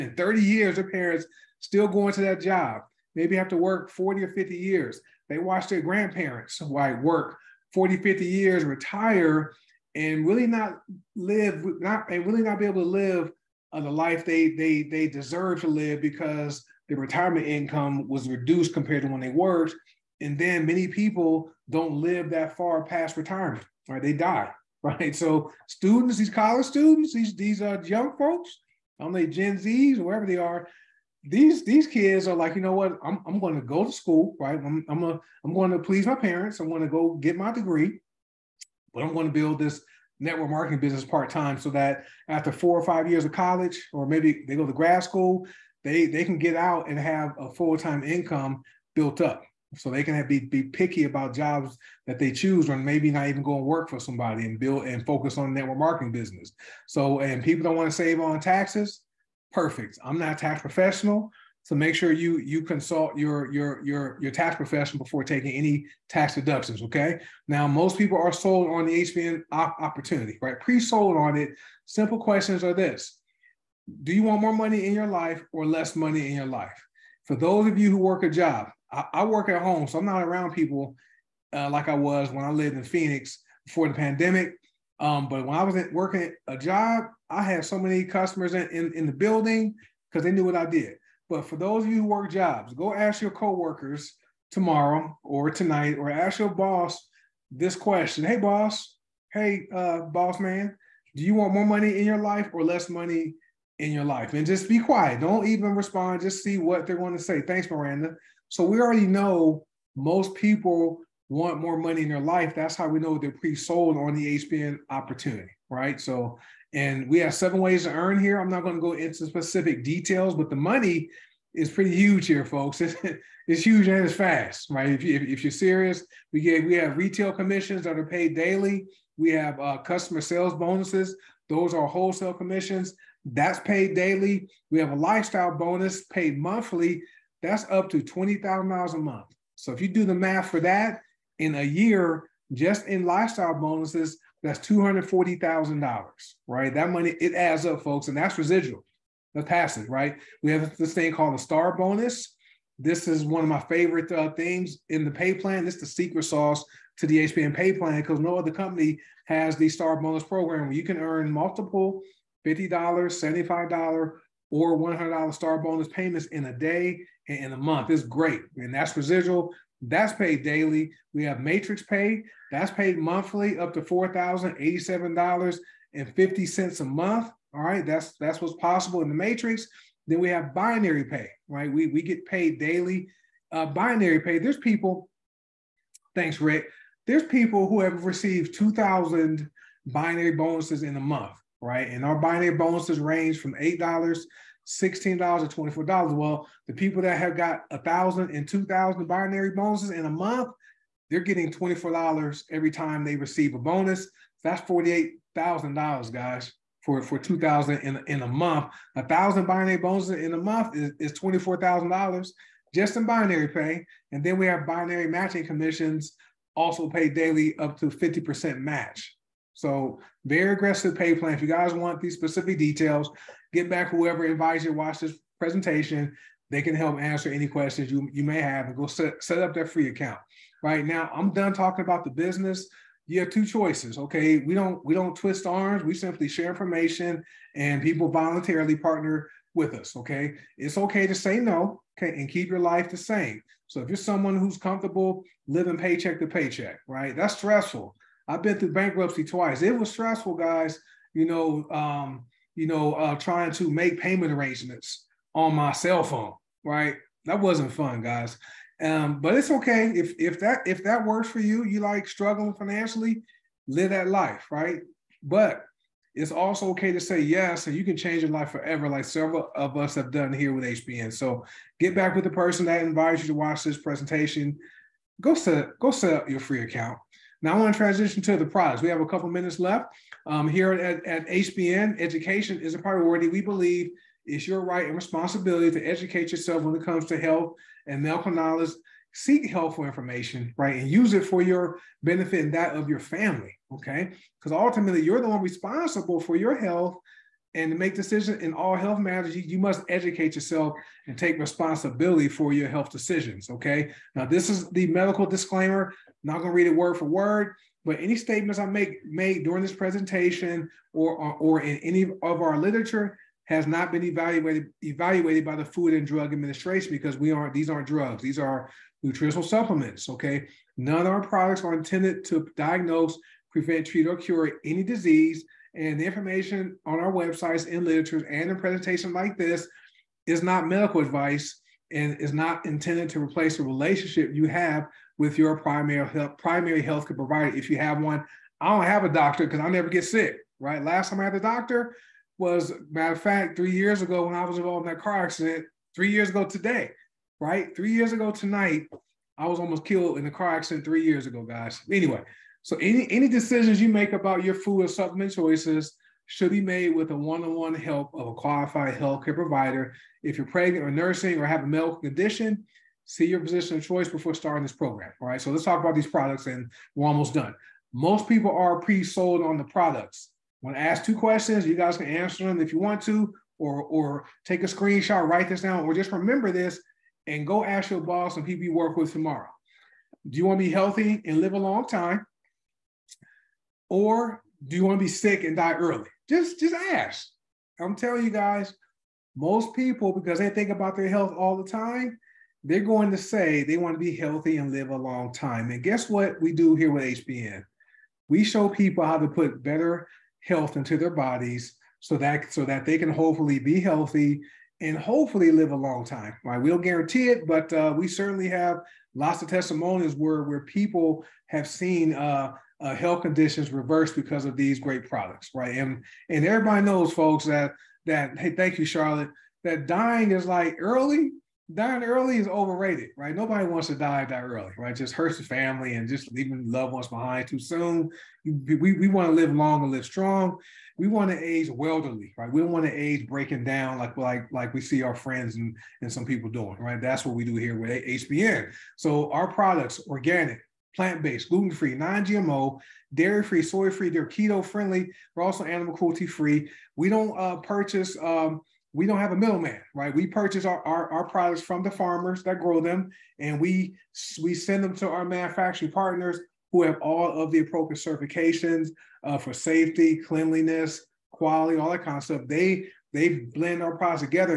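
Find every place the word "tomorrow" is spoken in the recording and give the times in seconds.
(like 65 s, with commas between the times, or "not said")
94 s, 379 s.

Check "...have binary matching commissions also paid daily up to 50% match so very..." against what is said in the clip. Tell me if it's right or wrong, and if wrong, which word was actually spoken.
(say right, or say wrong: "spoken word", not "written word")
right.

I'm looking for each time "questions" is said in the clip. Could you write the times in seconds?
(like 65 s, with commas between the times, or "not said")
72 s, 97 s, 227 s, 371 s.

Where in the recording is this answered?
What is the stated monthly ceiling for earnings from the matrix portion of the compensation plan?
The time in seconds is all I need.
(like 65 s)
173 s.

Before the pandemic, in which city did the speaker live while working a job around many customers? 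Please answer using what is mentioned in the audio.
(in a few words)
Phoenix.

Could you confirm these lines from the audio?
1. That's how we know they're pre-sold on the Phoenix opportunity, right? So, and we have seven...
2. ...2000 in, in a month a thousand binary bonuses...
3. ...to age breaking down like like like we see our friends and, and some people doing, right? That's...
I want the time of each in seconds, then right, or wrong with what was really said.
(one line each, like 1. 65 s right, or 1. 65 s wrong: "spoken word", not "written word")
1. 112 s wrong: "HBN", not "Phoenix"
2. 207 s right
3. 432 s right.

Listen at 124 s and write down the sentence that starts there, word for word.
If, you, if, you're serious, we get we have retail commissions that are paid daily.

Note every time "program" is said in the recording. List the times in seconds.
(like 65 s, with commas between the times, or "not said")
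160 s, 364 s.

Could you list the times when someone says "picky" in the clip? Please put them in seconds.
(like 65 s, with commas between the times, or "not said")
50 s.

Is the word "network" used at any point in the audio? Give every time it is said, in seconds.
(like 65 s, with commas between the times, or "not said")
40 s, 55 s.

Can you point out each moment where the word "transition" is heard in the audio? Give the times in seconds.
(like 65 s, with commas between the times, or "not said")
277 s.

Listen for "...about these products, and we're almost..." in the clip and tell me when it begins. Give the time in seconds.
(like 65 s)
365 s.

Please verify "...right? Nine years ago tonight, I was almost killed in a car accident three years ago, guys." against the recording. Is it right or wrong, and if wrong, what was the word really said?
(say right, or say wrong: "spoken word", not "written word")
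wrong: "Three", not "Nine".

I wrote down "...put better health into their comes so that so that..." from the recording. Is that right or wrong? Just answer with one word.
wrong.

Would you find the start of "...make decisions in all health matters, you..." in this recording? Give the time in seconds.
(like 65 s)
297 s.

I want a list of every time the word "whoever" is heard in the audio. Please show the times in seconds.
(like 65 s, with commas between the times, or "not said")
223 s.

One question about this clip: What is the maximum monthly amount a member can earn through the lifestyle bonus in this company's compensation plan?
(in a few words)
$20,000.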